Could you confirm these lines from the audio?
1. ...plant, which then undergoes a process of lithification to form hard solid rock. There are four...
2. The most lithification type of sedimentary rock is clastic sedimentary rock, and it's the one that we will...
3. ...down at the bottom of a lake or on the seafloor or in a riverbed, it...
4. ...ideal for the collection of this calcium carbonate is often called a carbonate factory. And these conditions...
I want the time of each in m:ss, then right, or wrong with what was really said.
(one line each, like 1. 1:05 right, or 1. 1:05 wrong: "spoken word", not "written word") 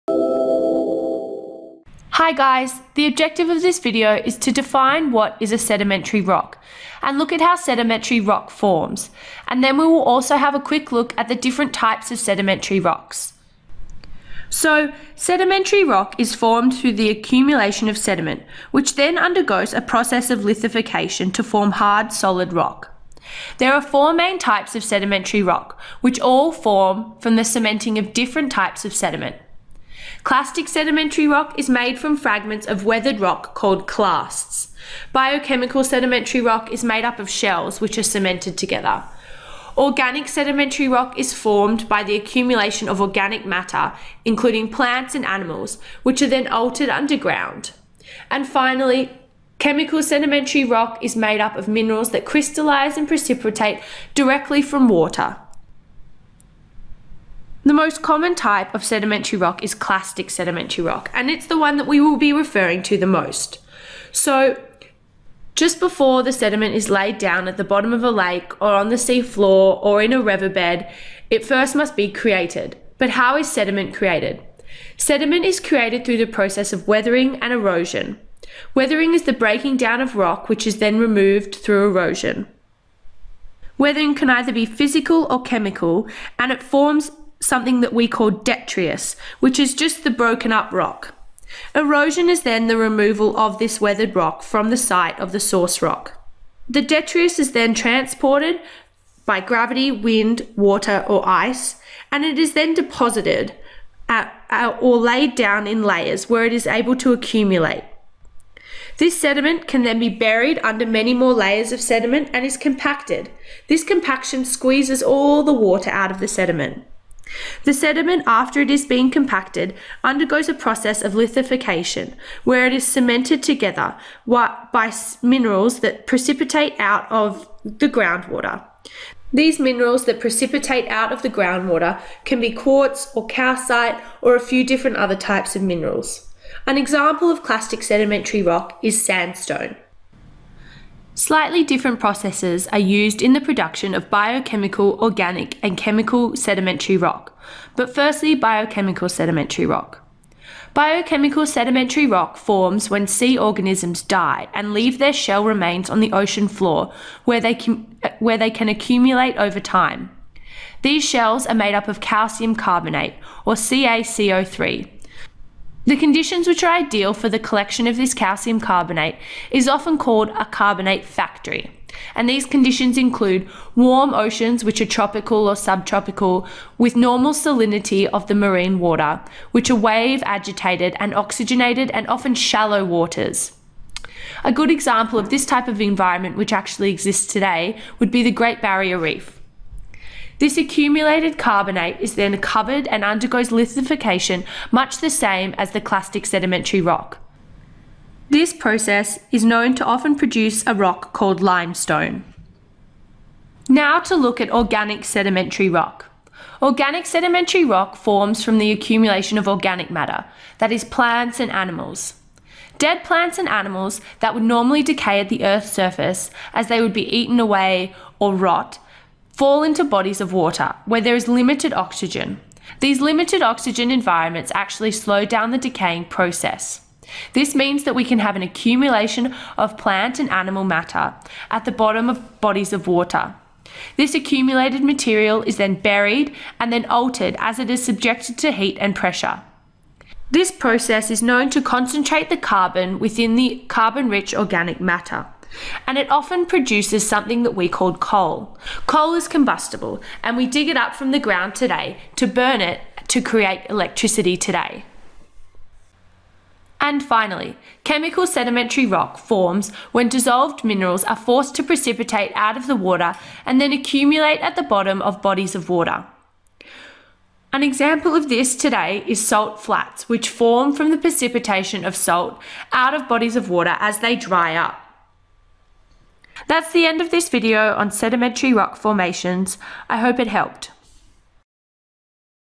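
1. 0:17 wrong: "sediment", not "plant"
2. 0:57 wrong: "common", not "lithification"
3. 1:07 right
4. 2:46 right.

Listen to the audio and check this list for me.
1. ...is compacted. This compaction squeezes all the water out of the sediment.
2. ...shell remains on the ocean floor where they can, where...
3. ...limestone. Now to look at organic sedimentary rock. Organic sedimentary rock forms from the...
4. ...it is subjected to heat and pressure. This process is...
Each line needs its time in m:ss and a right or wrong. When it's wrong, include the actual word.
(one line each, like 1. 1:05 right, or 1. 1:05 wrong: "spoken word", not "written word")
1. 1:52 right
2. 2:35 right
3. 3:21 right
4. 3:57 right.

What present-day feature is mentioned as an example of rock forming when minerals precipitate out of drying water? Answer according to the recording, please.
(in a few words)
salt flats.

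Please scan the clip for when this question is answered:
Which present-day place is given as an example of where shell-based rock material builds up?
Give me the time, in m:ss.
3:08.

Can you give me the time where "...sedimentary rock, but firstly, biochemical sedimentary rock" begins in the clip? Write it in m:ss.
2:26.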